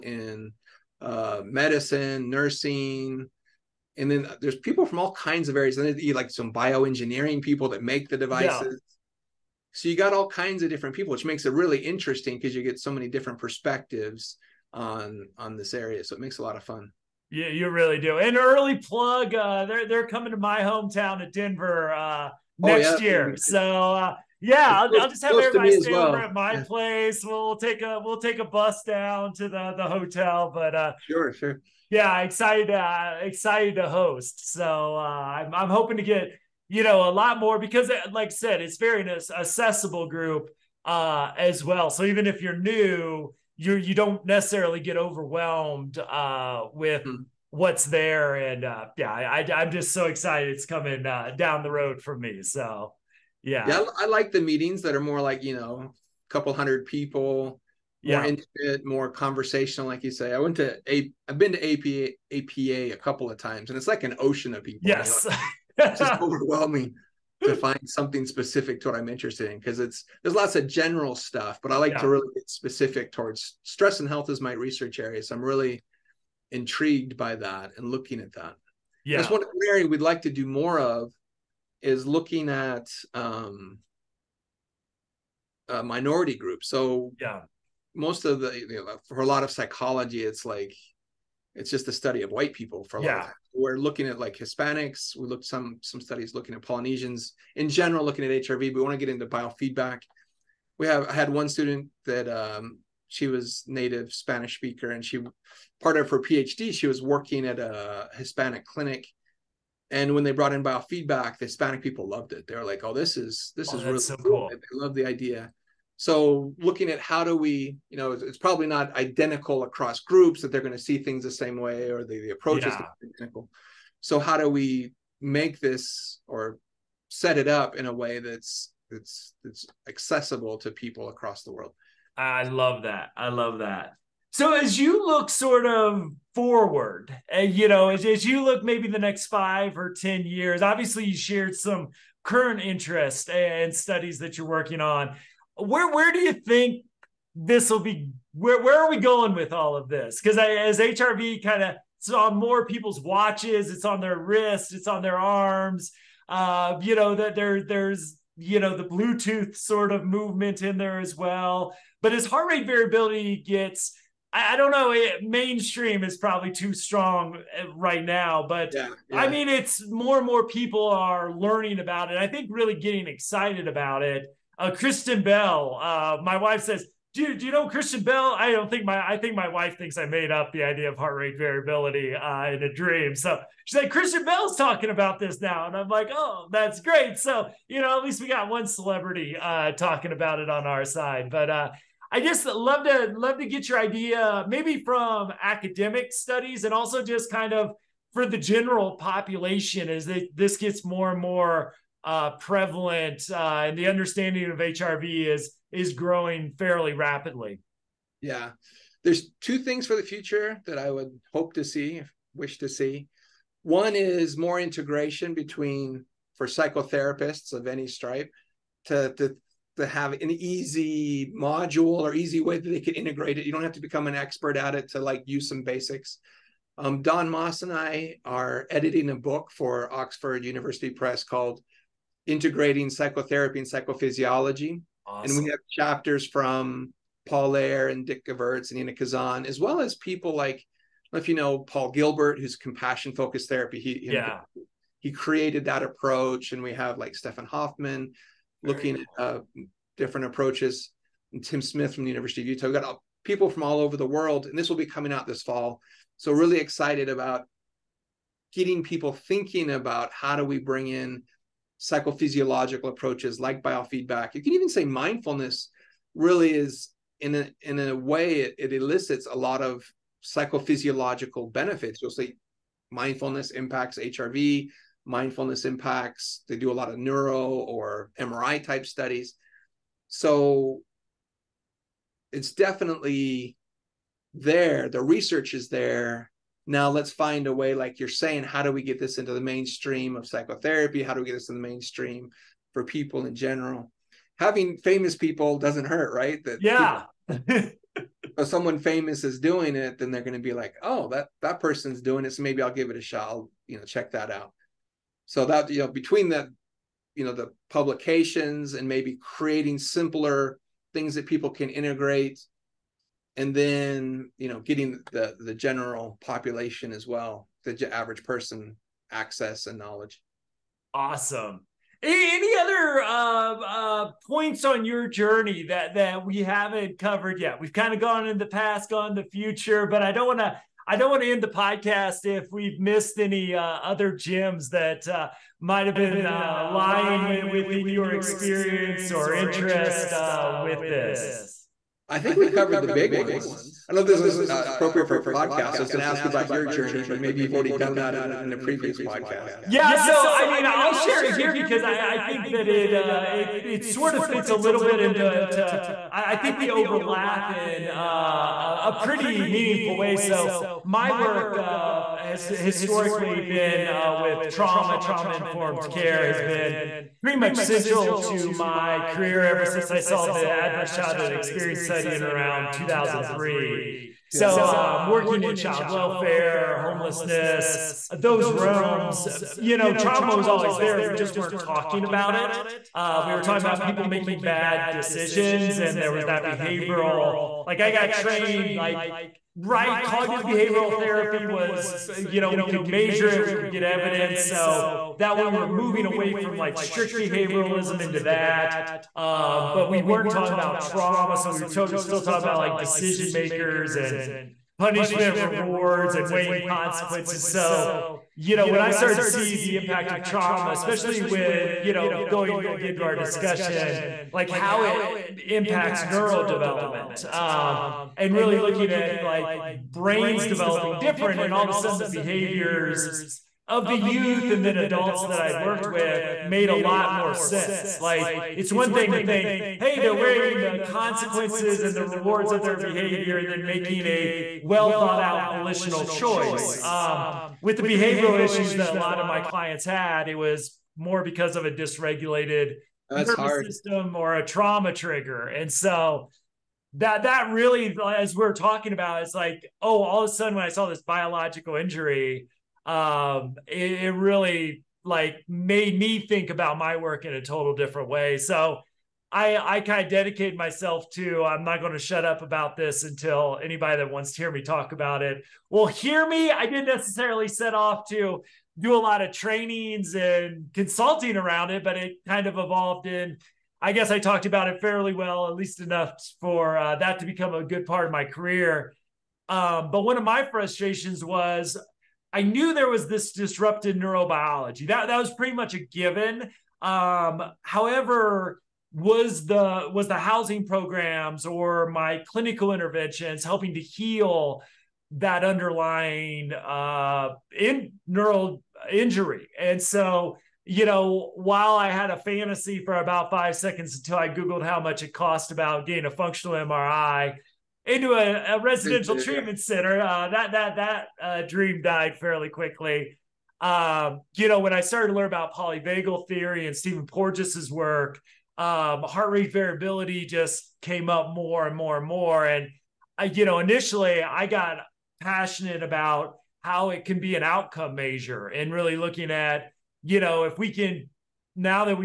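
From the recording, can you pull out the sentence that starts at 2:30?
Because as HRV kind of it's on more people's watches, it's on their wrists, it's on their arms.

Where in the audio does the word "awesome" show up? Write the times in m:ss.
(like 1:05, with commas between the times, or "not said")
3:55, 5:20.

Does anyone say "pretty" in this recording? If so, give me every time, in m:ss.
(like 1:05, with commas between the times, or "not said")
5:58, 6:07, 8:05.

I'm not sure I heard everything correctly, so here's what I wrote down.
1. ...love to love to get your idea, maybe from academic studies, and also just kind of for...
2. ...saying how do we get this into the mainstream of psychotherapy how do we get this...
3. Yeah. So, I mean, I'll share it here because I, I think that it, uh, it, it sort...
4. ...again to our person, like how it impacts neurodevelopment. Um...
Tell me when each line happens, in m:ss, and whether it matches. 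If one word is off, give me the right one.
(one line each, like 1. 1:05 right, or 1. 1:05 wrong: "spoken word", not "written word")
1. 3:12 right
2. 4:48 right
3. 5:49 right
4. 6:52 wrong: "discussion", not "person".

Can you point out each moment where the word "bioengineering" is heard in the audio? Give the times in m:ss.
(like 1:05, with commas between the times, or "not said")
0:06.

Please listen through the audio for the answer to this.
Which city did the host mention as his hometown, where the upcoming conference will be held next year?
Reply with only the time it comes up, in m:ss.
0:21.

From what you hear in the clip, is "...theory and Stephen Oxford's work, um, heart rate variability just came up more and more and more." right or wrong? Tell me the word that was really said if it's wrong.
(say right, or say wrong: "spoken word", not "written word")
wrong: "Porges", not "Oxford".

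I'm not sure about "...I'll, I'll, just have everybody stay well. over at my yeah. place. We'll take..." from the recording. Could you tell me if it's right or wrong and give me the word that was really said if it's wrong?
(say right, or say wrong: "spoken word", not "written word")
right.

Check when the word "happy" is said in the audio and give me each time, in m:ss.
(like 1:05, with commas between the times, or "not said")
not said.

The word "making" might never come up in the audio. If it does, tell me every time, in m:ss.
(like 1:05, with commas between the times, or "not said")
6:24, 7:13.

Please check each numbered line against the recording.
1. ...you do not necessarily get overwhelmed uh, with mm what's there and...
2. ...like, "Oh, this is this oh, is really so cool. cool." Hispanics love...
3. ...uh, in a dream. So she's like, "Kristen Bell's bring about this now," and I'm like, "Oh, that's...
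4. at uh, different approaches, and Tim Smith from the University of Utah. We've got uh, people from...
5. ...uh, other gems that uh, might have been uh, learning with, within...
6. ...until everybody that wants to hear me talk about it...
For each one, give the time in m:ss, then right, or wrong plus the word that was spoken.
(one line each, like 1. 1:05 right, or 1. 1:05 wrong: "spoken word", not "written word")
1. 0:43 right
2. 1:52 wrong: "They", not "Hispanics"
3. 3:02 wrong: "talking", not "bring"
4. 4:09 right
5. 5:33 wrong: "lying", not "learning"
6. 7:43 wrong: "anybody", not "everybody".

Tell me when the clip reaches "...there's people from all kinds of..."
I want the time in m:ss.
0:04.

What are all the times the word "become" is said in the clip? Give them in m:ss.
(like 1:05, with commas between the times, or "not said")
3:43, 7:57.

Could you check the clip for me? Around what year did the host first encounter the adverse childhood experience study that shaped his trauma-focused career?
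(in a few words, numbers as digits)
2003.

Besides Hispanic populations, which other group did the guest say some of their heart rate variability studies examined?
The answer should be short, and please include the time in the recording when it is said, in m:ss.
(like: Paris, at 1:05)
Polynesians, at 1:36.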